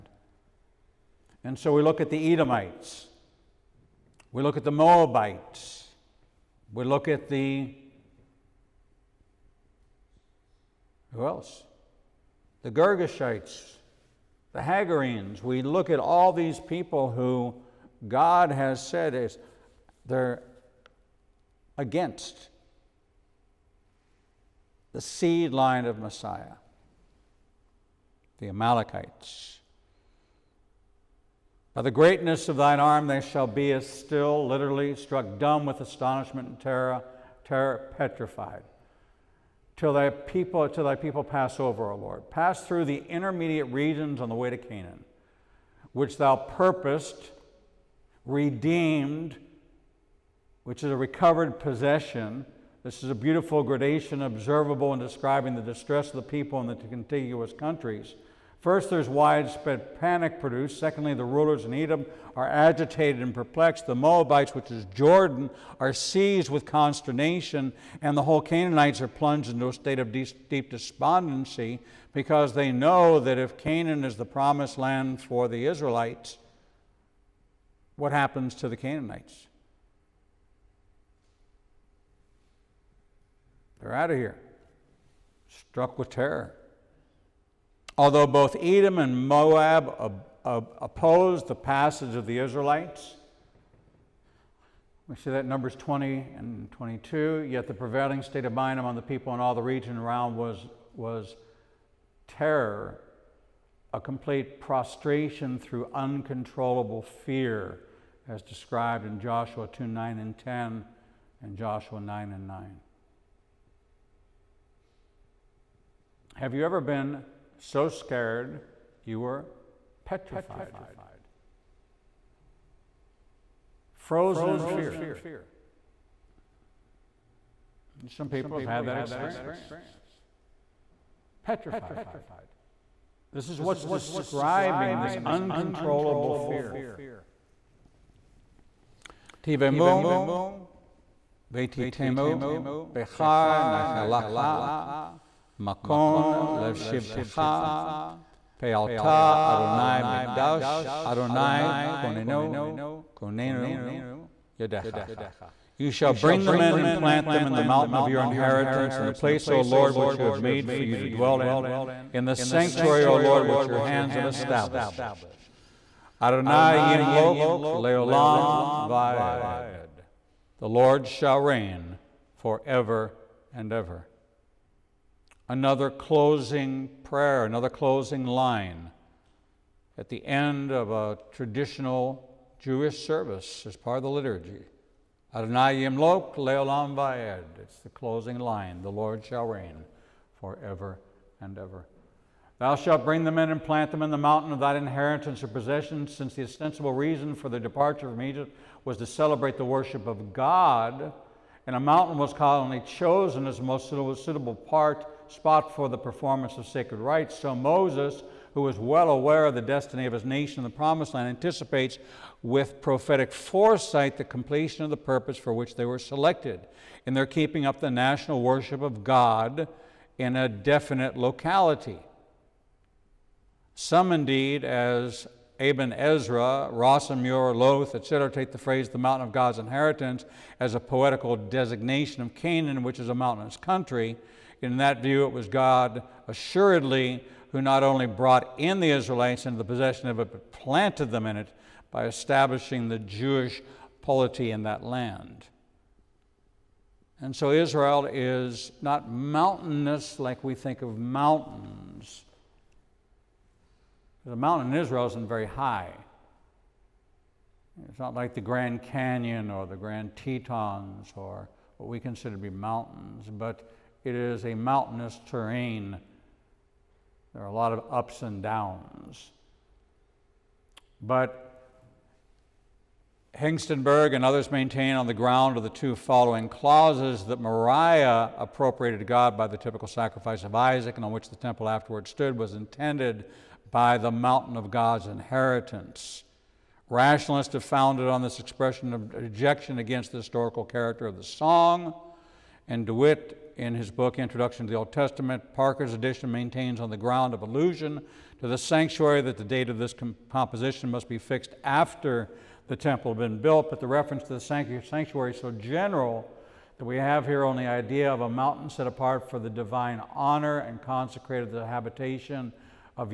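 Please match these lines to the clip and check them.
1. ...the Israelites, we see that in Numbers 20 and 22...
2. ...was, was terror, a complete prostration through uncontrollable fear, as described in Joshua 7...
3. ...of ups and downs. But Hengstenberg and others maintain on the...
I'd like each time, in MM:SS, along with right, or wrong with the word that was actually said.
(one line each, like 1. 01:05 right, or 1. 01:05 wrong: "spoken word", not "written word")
1. 01:32 right
2. 01:40 wrong: "2", not "7"
3. 04:27 right.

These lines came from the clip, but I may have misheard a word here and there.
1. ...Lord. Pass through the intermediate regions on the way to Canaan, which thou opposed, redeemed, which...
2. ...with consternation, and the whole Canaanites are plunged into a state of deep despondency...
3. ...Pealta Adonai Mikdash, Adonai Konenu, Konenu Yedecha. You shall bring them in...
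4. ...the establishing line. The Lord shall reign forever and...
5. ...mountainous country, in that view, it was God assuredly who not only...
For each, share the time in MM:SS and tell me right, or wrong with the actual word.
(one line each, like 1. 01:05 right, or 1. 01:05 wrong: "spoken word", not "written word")
1. 00:41 wrong: "purposed", not "opposed"
2. 01:06 right
3. 02:28 right
4. 03:07 wrong: "closing", not "establishing"
5. 03:53 right.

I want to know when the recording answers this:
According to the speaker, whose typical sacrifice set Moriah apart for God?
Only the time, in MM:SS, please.
04:40.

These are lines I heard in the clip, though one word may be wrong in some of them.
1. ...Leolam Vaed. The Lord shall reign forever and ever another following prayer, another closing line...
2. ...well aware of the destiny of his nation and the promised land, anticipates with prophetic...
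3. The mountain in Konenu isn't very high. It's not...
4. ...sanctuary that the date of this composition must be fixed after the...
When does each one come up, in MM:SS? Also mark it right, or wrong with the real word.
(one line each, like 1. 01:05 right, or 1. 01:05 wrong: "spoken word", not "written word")
1. 02:47 wrong: "closing", not "following"
2. 03:28 right
3. 04:14 wrong: "Israel", not "Konenu"
4. 04:58 right.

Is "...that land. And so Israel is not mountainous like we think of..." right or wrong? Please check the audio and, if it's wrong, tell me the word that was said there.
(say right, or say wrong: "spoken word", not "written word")
right.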